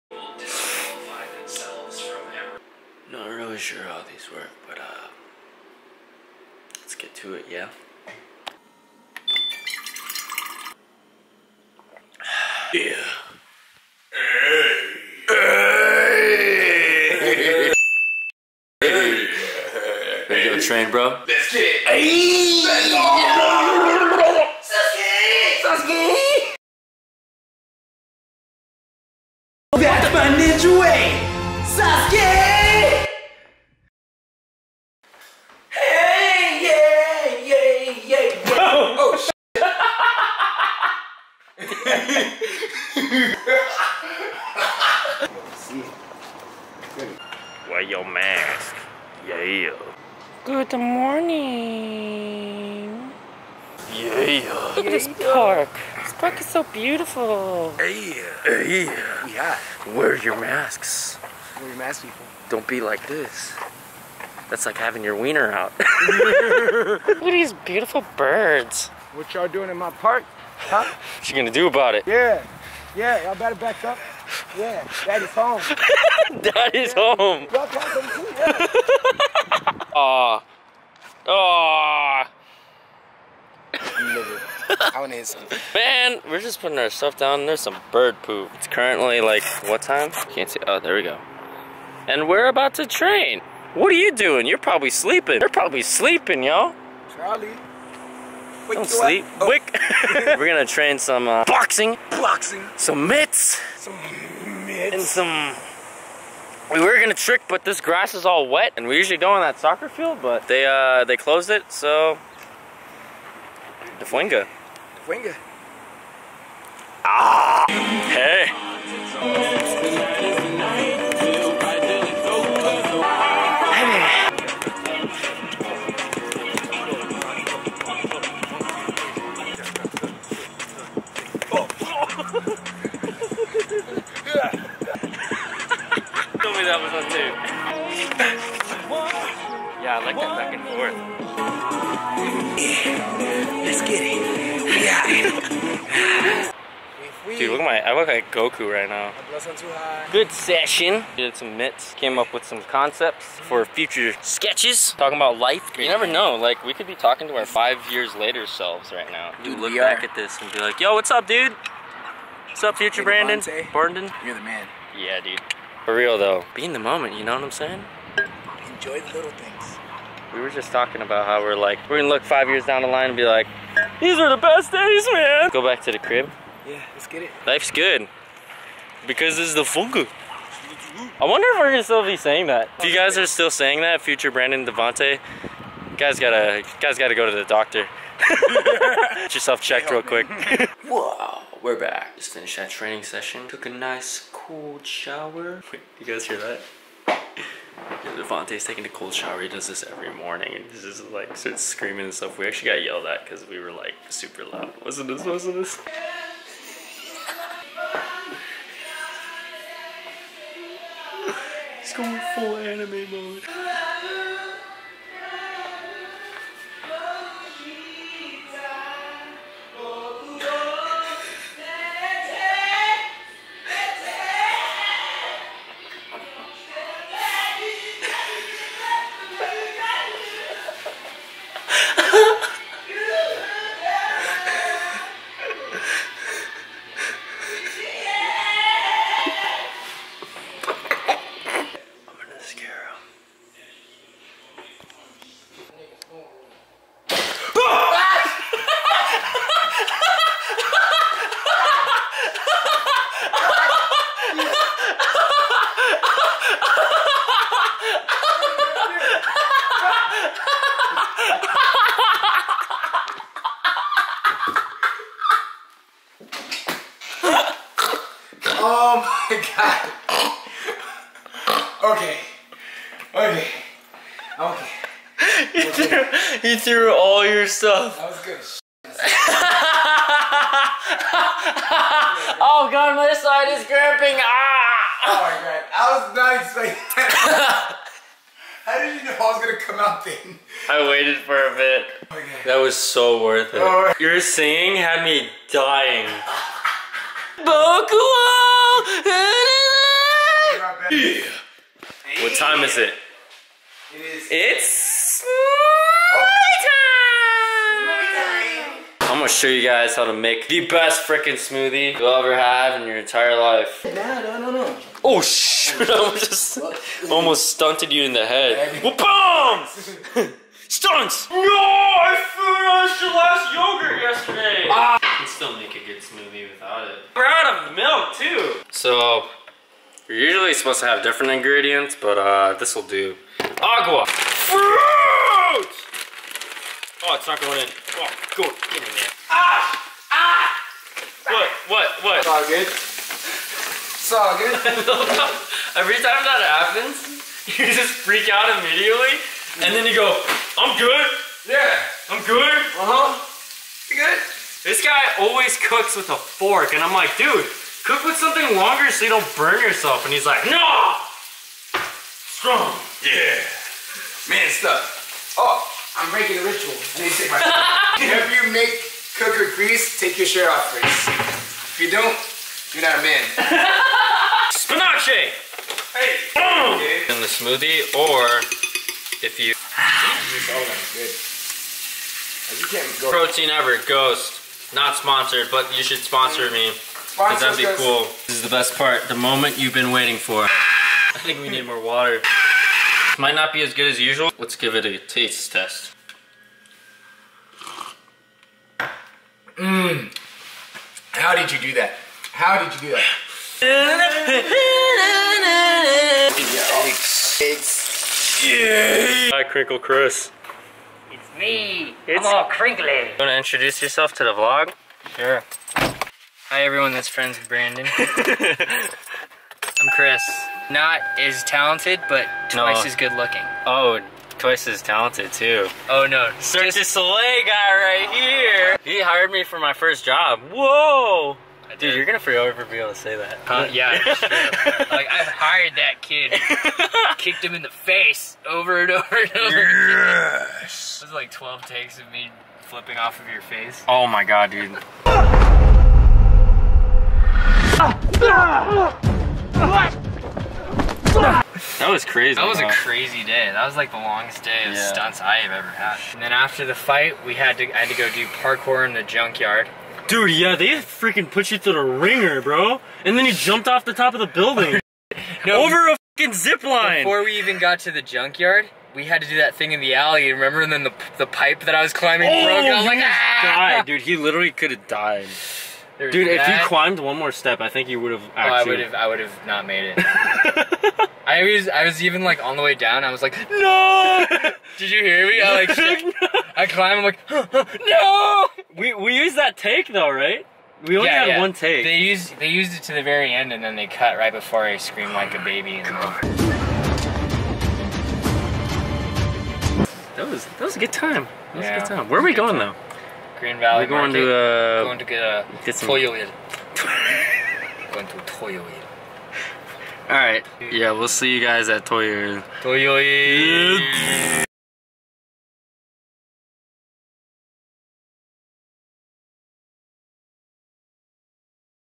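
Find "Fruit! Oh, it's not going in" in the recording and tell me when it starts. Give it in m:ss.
5:34.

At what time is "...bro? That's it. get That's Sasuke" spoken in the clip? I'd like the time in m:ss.
0:20.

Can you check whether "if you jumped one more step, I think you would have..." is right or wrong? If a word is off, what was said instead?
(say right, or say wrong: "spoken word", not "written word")
wrong: "climbed", not "jumped".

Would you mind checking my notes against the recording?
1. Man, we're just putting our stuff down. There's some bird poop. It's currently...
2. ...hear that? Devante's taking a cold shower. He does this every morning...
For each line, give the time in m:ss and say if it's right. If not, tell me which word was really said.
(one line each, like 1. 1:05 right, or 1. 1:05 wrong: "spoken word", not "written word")
1. 1:25 right
2. 3:16 right.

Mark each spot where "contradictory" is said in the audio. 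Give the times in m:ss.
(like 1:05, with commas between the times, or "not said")
not said.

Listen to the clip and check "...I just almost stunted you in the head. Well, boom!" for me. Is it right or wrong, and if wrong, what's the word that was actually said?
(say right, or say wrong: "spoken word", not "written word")
right.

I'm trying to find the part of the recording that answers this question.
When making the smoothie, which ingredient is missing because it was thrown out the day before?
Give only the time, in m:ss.
5:23.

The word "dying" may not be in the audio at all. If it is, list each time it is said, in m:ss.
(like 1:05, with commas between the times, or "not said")
4:55.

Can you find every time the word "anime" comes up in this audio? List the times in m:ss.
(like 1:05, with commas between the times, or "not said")
3:32.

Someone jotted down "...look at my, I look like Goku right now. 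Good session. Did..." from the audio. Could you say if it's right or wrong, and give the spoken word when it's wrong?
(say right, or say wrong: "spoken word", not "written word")
right.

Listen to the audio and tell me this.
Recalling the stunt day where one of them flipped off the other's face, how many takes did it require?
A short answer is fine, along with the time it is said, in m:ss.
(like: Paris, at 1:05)
12, at 7:21.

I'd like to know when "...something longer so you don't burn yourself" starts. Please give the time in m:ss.
5:58.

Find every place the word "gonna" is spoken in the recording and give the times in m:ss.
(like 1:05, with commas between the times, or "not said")
1:11, 1:46, 2:51, 3:01, 4:49, 5:09, 7:12.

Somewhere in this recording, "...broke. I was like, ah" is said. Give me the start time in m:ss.
7:52.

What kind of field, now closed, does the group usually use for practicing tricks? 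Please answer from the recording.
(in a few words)
Soccer field.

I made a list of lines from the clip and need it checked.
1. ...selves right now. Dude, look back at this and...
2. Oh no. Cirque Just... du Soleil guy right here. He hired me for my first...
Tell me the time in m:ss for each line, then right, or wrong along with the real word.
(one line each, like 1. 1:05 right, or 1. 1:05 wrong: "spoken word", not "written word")
1. 2:38 right
2. 7:05 right.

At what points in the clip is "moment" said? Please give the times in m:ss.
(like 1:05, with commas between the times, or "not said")
2:46, 6:29.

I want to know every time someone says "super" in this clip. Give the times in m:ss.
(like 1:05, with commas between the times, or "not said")
3:24.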